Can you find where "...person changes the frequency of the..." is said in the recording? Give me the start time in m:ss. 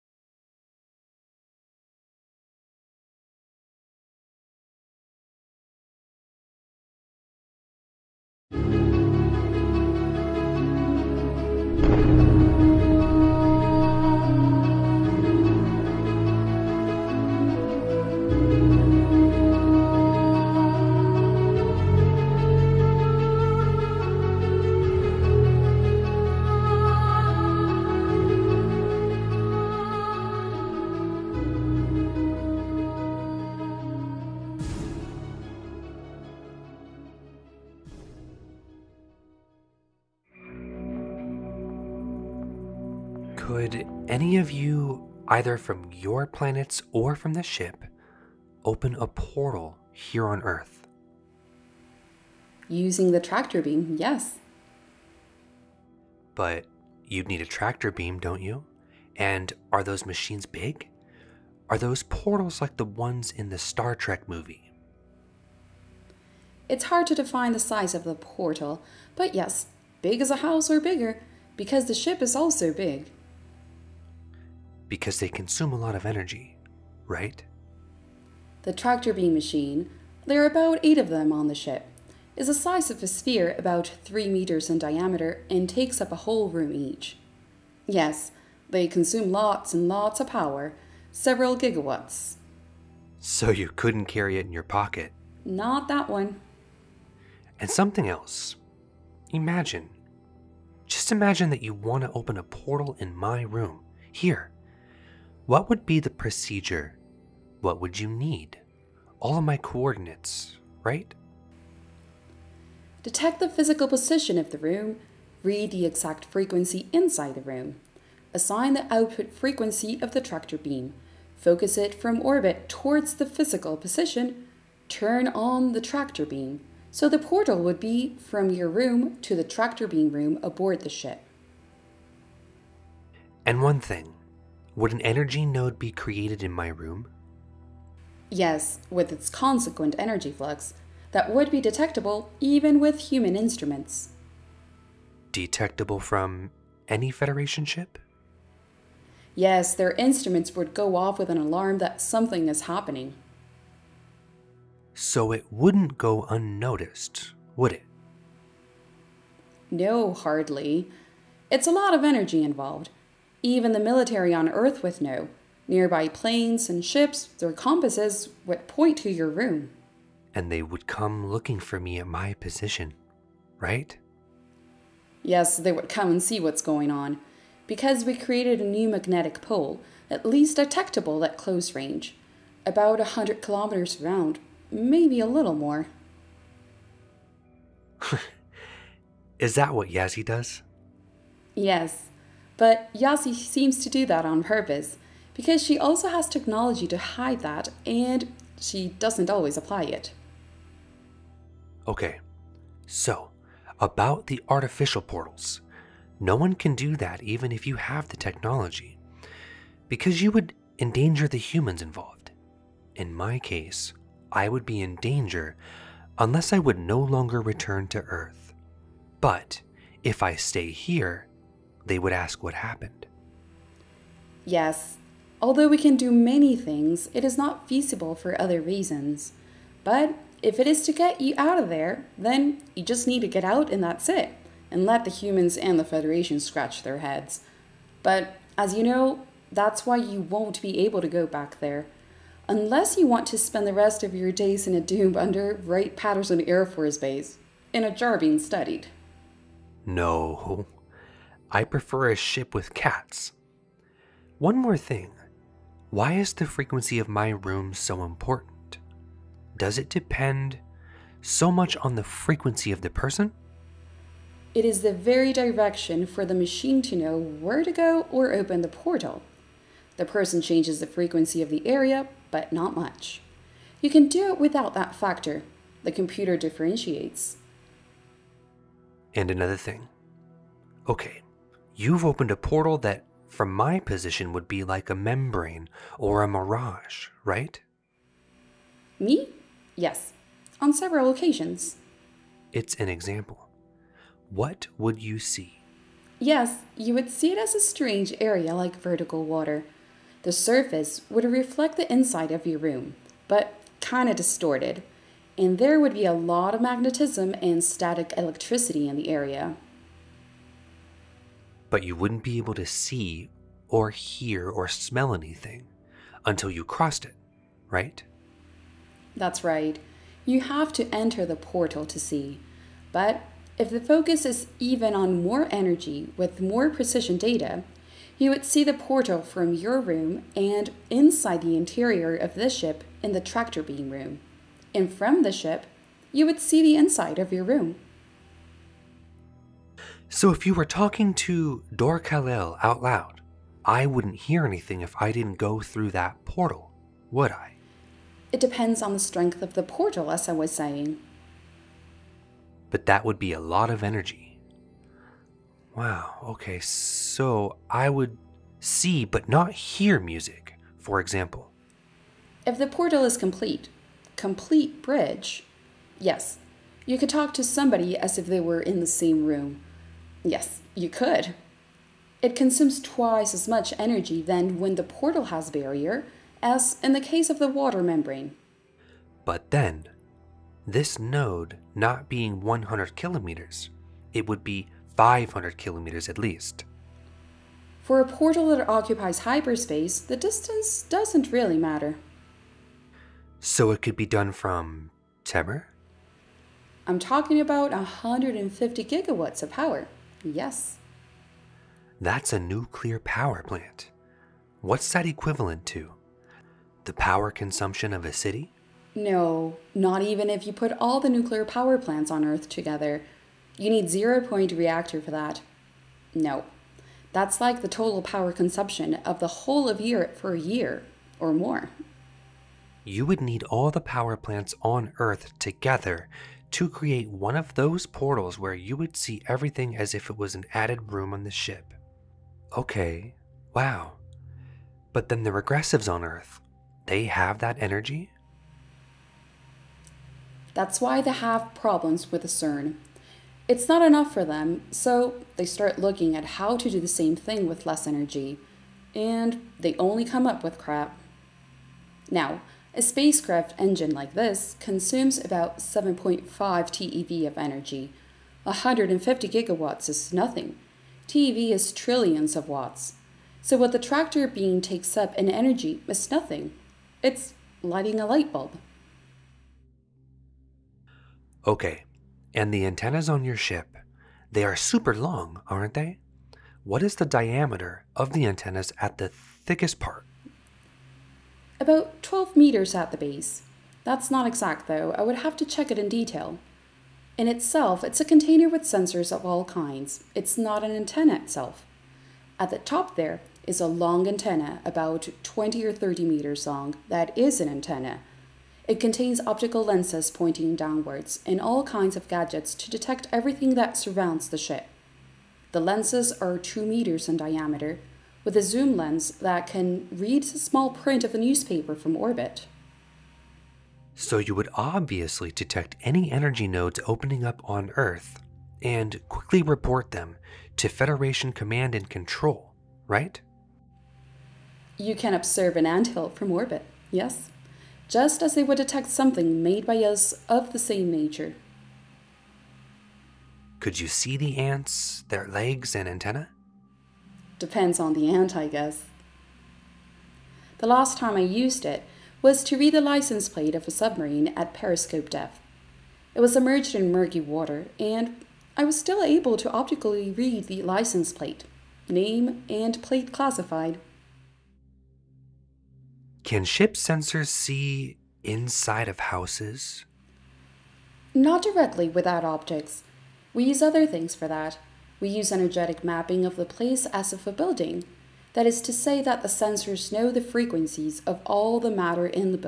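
4:30.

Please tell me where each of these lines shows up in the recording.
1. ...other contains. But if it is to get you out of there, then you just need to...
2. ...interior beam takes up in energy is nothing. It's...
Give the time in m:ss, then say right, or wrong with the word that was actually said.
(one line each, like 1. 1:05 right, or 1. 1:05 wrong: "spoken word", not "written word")
1. 3:48 wrong: "reasons", not "contains"
2. 7:43 wrong: "tractor", not "interior".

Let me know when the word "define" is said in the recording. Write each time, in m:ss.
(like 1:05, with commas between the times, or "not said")
1:07.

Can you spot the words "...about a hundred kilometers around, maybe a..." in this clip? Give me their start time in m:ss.
3:02.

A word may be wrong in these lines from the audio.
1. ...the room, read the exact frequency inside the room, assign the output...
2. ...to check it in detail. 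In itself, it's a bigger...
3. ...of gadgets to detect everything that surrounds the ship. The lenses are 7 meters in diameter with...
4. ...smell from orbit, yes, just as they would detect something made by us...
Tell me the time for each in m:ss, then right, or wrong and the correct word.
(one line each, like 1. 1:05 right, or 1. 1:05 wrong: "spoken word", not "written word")
1. 1:54 right
2. 8:05 wrong: "container", not "bigger"
3. 8:21 wrong: "2", not "7"
4. 8:45 wrong: "anthill", not "smell".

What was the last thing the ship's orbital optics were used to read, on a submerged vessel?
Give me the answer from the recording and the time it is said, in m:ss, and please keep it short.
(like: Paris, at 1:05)
license plate of a submarine, at 9:02.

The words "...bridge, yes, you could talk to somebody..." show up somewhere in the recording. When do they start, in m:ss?
6:04.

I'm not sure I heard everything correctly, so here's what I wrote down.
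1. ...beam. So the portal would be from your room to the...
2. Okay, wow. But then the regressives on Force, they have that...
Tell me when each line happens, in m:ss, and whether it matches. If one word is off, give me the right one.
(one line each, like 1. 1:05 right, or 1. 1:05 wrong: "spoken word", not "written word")
1. 2:06 right
2. 7:12 wrong: "Earth", not "Force".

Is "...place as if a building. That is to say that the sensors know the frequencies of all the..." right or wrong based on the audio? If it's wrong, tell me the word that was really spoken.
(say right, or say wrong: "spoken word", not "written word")
right.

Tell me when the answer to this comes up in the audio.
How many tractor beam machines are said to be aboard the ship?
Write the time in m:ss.
1:20.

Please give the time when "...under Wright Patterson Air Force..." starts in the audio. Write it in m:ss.
4:05.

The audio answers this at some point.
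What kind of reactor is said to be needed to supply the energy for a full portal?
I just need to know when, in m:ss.
6:53.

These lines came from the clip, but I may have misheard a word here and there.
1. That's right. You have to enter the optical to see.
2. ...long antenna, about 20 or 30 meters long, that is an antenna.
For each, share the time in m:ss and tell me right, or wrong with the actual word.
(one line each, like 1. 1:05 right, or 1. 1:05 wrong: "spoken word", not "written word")
1. 5:19 wrong: "portal", not "optical"
2. 8:13 right.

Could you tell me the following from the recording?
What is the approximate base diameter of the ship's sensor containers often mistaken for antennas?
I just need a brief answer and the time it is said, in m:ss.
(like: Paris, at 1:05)
12 meters, at 8:01.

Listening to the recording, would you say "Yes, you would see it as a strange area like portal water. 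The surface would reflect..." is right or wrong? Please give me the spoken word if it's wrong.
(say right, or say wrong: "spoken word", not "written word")
wrong: "vertical", not "portal".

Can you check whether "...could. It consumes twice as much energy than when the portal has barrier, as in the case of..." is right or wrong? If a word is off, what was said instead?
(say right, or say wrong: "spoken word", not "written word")
right.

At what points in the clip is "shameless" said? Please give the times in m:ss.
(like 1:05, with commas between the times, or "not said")
not said.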